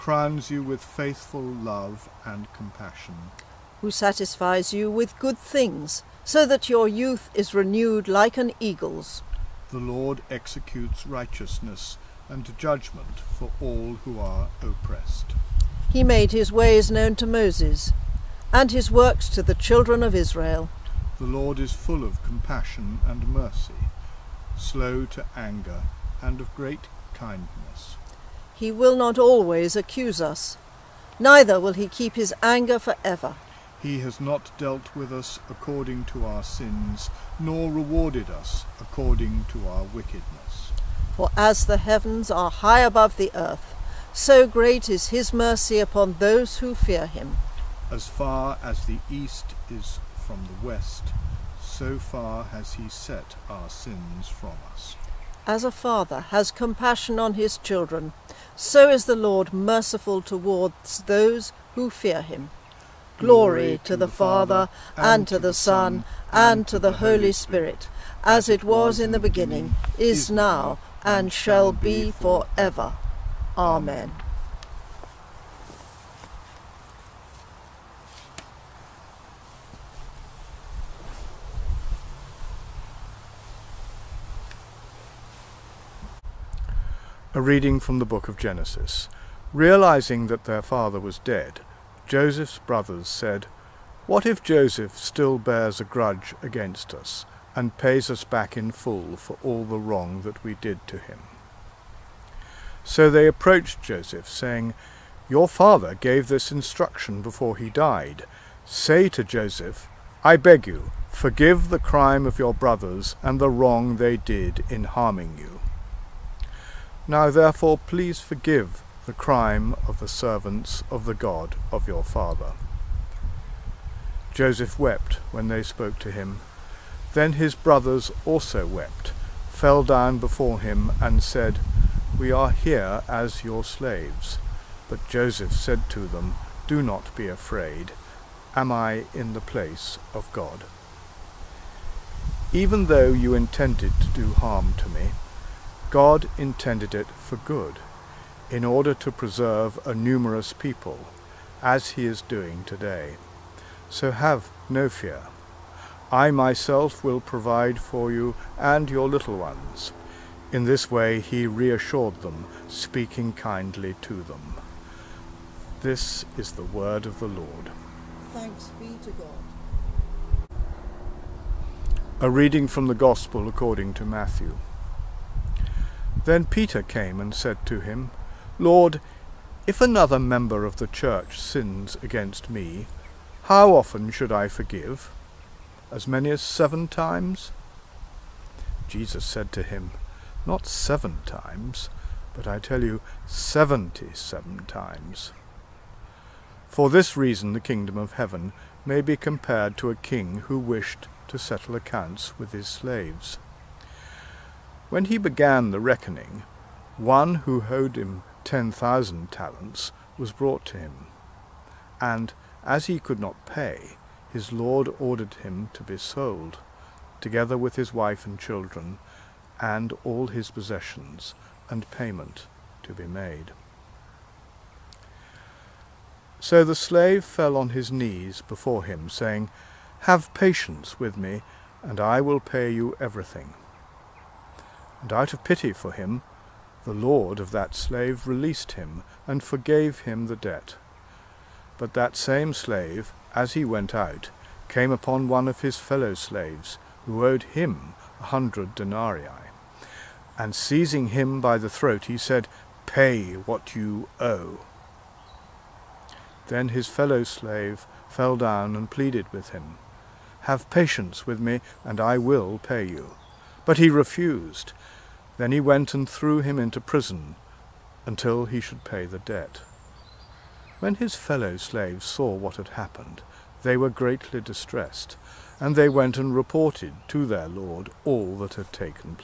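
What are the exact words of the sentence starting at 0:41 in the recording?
For as the heavens are high above the earth, so great is his mercy upon those who fear him.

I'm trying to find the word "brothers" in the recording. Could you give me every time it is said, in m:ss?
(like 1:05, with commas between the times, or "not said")
1:32, 1:52, 2:07.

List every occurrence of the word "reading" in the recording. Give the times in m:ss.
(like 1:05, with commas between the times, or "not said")
1:27, 2:52.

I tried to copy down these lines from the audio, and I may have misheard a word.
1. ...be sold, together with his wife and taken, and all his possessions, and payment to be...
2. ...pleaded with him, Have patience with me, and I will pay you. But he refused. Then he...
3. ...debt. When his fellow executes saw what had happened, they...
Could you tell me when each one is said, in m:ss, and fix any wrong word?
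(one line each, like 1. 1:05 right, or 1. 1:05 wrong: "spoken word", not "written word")
1. 3:35 wrong: "children", not "taken"
2. 4:18 right
3. 4:29 wrong: "slaves", not "executes".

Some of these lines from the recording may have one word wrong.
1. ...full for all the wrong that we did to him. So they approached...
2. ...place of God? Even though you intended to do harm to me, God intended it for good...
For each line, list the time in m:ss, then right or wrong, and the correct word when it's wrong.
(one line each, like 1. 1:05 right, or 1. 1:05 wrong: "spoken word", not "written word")
1. 1:38 right
2. 2:19 right.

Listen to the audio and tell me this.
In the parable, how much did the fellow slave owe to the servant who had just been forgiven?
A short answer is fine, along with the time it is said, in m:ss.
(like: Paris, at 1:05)
100 denarii, at 4:08.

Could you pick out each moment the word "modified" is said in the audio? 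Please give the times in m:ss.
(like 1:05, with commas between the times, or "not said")
not said.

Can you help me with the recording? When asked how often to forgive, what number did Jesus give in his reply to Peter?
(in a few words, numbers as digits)
77.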